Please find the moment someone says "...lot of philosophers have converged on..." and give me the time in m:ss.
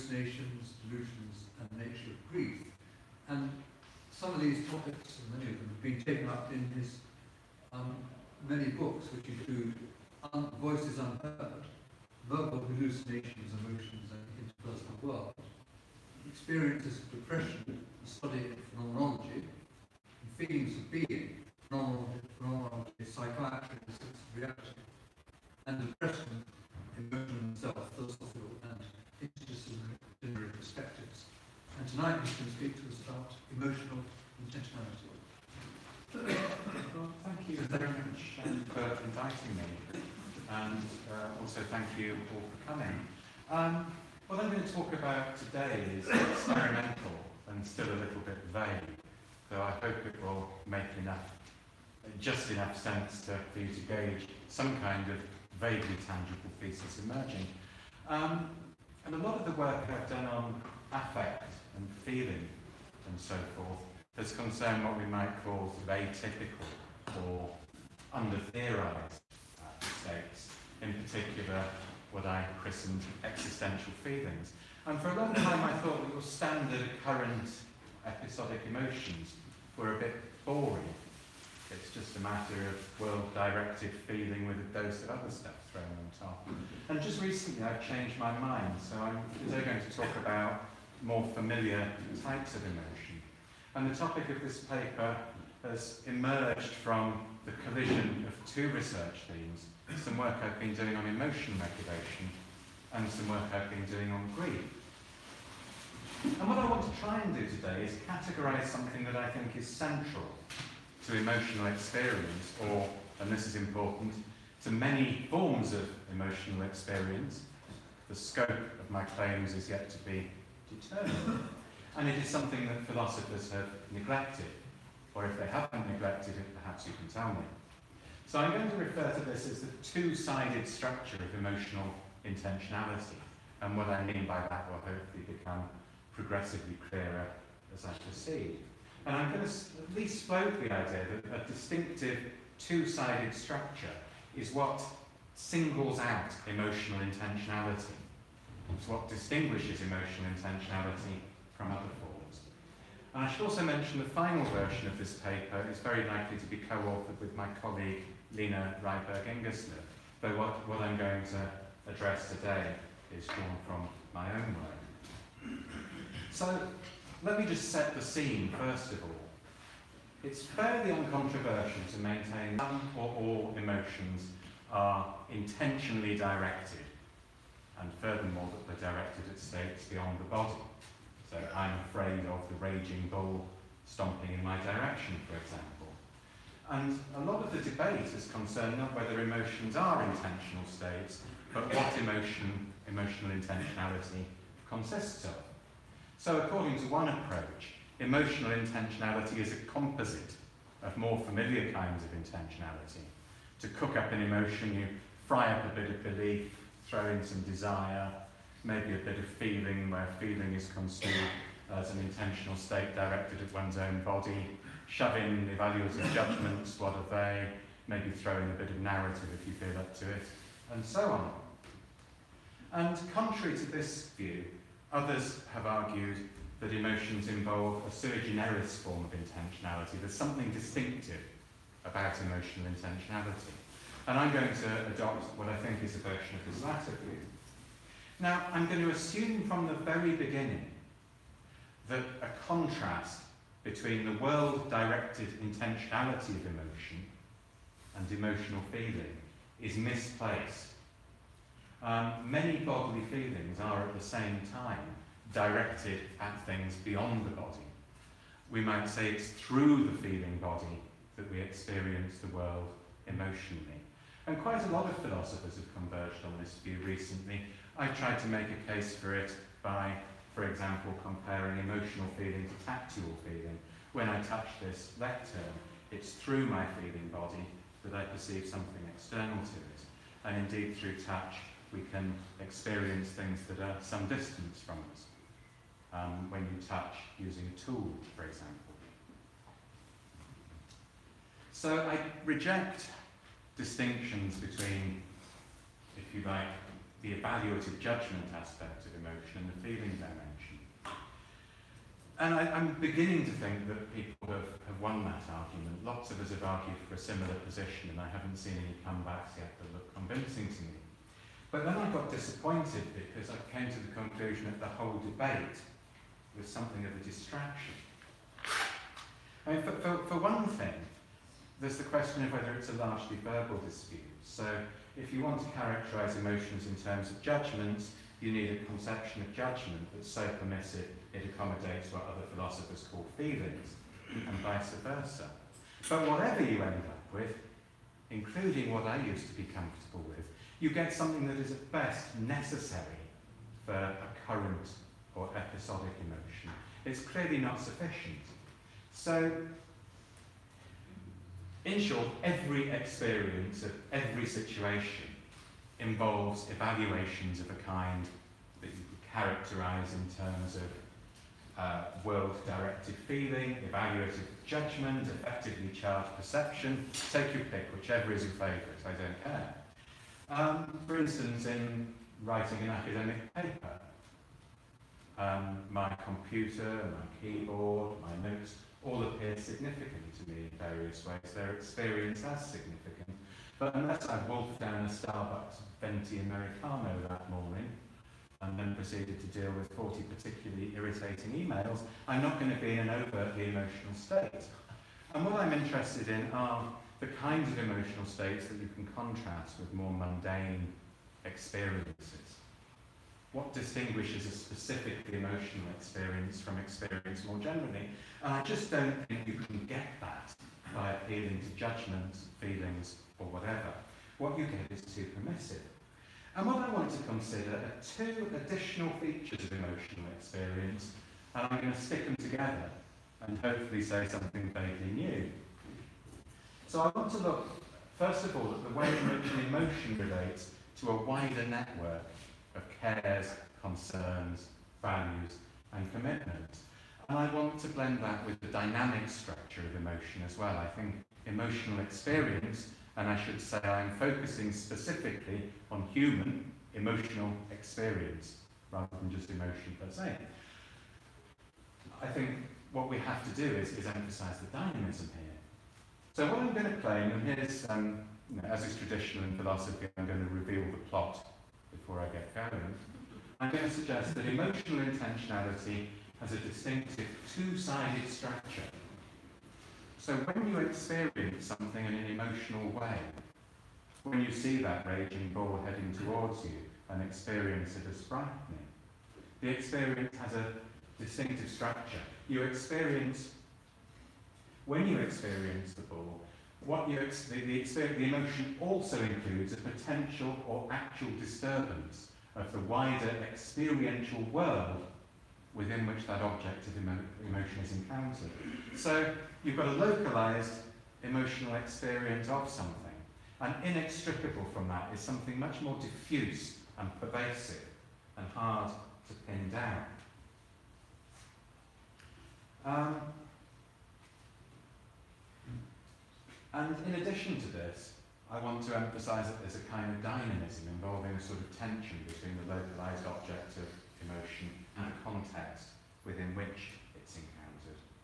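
4:24.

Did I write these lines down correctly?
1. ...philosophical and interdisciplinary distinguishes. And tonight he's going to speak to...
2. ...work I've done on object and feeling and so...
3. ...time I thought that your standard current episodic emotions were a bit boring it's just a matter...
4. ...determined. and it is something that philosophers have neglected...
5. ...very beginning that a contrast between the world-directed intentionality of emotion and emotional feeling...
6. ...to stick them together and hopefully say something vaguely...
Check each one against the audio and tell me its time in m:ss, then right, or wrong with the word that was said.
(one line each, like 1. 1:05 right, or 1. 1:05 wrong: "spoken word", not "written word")
1. 0:27 wrong: "perspectives", not "distinguishes"
2. 0:59 wrong: "affect", not "object"
3. 1:15 right
4. 2:00 right
5. 3:59 right
6. 7:01 right.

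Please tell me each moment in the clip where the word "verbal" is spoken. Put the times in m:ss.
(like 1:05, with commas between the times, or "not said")
0:12, 5:23.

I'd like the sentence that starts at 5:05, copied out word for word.
Lots of us have argued for a similar position, and I haven't seen any comebacks yet that look convincing to me.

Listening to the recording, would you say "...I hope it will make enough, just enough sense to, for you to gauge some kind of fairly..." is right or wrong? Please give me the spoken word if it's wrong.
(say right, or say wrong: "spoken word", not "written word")
wrong: "vaguely", not "fairly".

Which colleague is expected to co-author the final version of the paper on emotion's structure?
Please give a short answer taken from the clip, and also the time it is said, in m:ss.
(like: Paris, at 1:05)
Line Ryberg Ingerslev, at 2:38.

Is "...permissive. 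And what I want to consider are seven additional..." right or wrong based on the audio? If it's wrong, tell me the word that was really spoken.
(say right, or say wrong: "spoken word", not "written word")
wrong: "two", not "seven".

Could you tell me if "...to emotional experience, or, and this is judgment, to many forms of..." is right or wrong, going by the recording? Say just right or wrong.
wrong.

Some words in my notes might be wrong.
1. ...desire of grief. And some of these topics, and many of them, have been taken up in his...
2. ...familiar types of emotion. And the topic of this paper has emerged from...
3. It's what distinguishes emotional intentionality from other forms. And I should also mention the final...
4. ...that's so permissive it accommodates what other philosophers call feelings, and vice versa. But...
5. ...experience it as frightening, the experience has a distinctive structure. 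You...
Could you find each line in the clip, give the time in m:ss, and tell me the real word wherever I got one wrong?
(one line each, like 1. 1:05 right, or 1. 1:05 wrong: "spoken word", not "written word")
1. 0:01 wrong: "nature", not "desire"
2. 1:31 right
3. 2:28 right
4. 5:29 right
5. 7:57 right.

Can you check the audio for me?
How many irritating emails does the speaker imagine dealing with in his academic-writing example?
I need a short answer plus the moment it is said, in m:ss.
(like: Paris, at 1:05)
40, at 6:29.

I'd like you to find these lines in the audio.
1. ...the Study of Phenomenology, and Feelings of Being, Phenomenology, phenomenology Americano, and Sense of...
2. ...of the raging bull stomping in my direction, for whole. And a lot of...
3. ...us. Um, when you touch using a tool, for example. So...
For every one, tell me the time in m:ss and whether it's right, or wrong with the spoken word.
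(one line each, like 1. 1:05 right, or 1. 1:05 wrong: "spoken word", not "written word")
1. 0:17 wrong: "Psychiatry", not "Americano"
2. 3:02 wrong: "example", not "whole"
3. 4:44 right.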